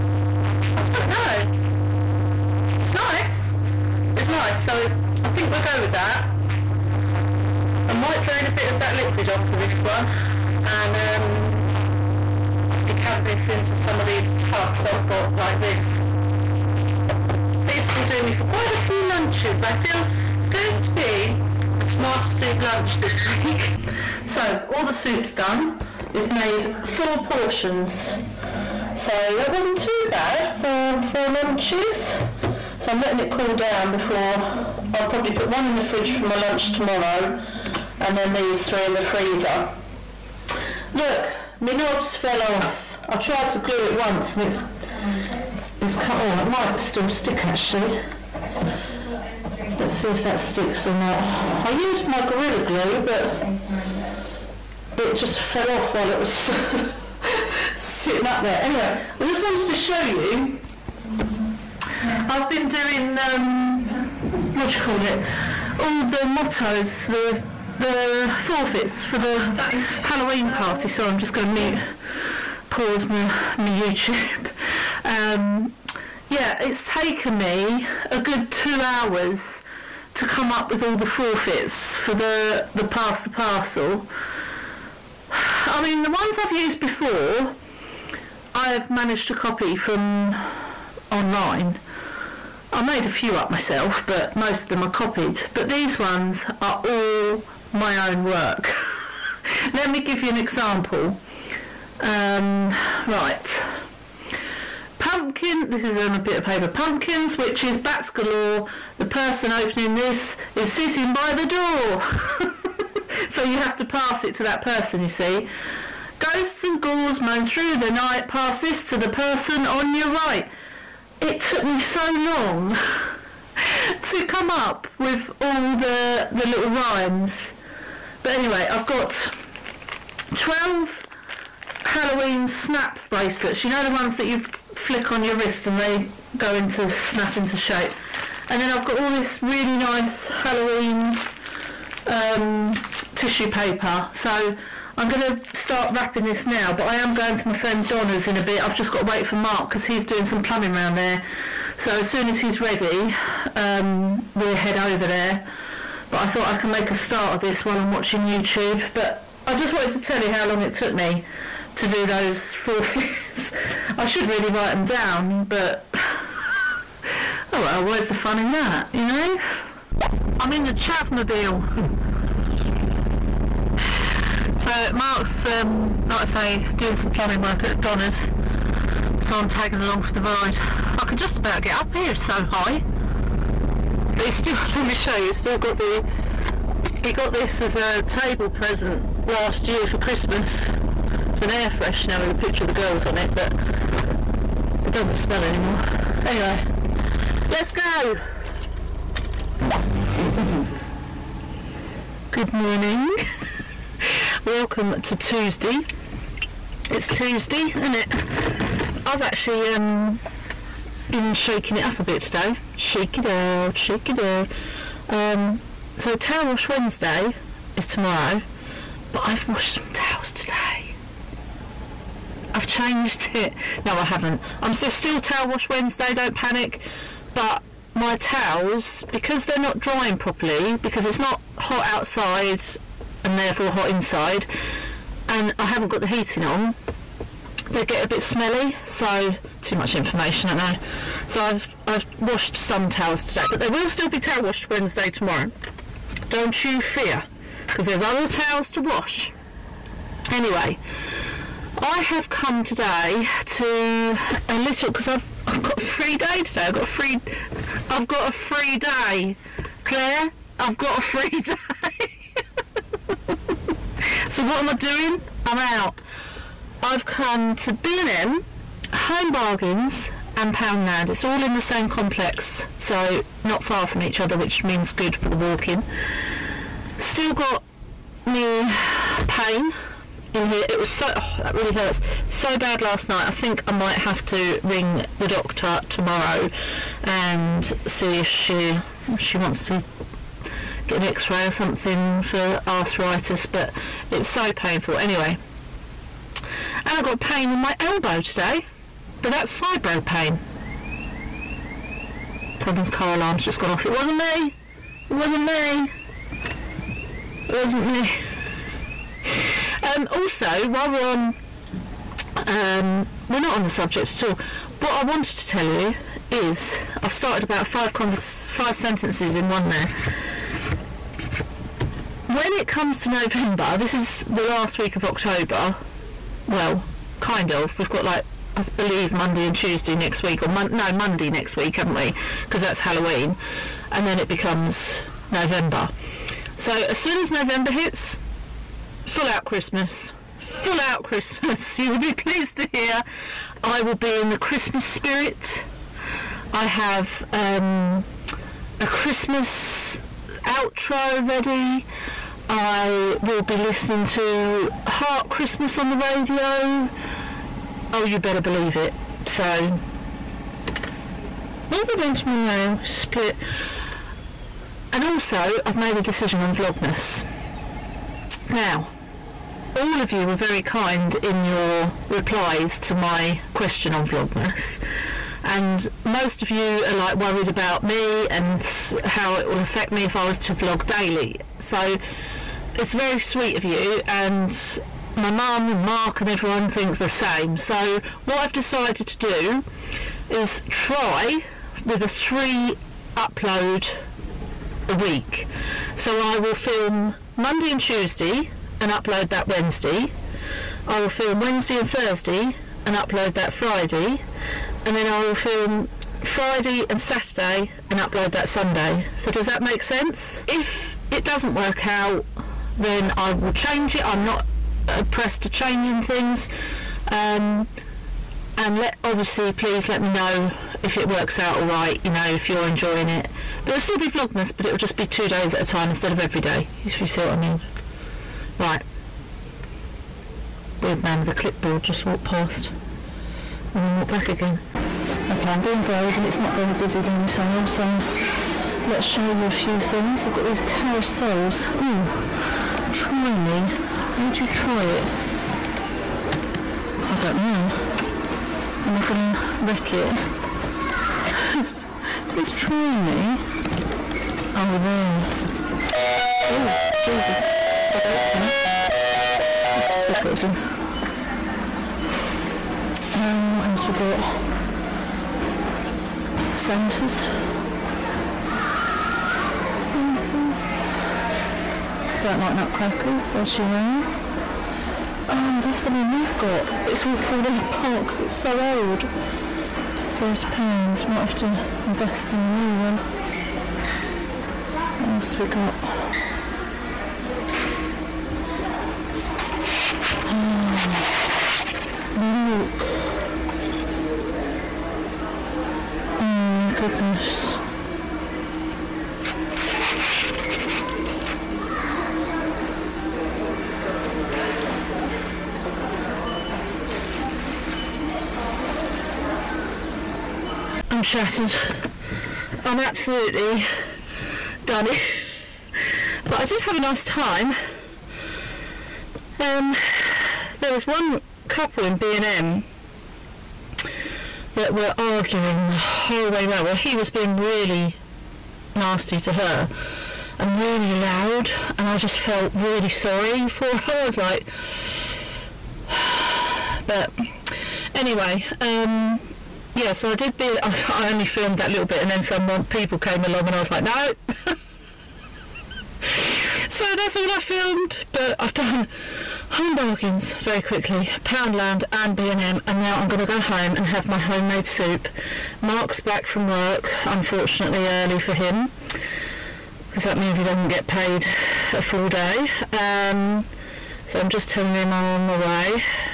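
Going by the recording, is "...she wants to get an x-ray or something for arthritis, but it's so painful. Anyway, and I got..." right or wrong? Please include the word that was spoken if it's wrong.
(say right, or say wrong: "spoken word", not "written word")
right.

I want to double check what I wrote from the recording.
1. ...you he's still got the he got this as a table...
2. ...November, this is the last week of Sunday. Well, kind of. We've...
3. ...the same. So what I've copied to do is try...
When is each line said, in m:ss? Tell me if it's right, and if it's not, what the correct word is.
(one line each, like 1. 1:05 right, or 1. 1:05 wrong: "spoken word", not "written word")
1. 3:05 right
2. 5:23 wrong: "October", not "Sunday"
3. 6:26 wrong: "decided", not "copied".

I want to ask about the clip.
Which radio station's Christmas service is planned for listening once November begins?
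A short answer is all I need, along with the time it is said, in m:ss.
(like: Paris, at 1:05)
Heart Christmas, at 5:54.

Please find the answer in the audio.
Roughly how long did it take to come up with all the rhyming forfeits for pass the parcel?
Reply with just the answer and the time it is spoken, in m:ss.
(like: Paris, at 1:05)
2 hours, at 1:18.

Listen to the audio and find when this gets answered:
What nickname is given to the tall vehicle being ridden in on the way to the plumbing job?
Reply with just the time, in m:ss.
2:50.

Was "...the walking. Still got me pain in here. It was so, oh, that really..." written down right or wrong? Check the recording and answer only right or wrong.
right.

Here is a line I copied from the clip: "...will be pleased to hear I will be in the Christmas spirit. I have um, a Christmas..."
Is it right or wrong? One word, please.
right.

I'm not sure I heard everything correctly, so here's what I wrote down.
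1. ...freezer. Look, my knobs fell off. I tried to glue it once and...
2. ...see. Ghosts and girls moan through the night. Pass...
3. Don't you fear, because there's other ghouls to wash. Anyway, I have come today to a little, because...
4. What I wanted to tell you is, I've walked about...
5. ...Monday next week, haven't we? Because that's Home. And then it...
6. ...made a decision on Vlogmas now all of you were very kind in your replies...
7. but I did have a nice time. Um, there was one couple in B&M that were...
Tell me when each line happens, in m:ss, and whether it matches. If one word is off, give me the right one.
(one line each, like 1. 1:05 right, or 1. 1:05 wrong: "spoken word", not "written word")
1. 0:39 right
2. 1:55 wrong: "ghouls", not "girls"
3. 4:06 wrong: "towels", not "ghouls"
4. 5:14 wrong: "started", not "walked"
5. 5:30 wrong: "Halloween", not "Home"
6. 6:05 right
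7. 8:36 right.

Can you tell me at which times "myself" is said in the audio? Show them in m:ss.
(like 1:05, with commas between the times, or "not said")
1:33.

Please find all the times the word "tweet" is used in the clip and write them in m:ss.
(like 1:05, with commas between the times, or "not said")
not said.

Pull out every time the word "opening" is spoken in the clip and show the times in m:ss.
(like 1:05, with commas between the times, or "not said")
1:49.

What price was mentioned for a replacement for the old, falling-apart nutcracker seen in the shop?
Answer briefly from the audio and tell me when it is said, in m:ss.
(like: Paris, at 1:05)
£30, at 8:00.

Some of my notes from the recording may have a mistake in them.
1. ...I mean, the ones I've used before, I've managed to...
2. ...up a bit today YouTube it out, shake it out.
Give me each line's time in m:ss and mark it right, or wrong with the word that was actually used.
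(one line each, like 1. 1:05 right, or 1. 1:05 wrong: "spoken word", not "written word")
1. 1:25 right
2. 3:31 wrong: "Shake", not "YouTube".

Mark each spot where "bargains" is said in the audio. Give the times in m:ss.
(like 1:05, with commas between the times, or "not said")
4:29, 9:09.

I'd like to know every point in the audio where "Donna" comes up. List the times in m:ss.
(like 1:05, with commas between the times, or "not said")
2:27, 2:57.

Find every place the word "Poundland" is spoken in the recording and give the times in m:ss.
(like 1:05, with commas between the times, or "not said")
4:30, 9:11.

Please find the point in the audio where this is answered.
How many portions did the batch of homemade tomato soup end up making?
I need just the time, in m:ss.
0:26.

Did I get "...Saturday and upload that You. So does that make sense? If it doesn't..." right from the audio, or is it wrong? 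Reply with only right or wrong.
wrong.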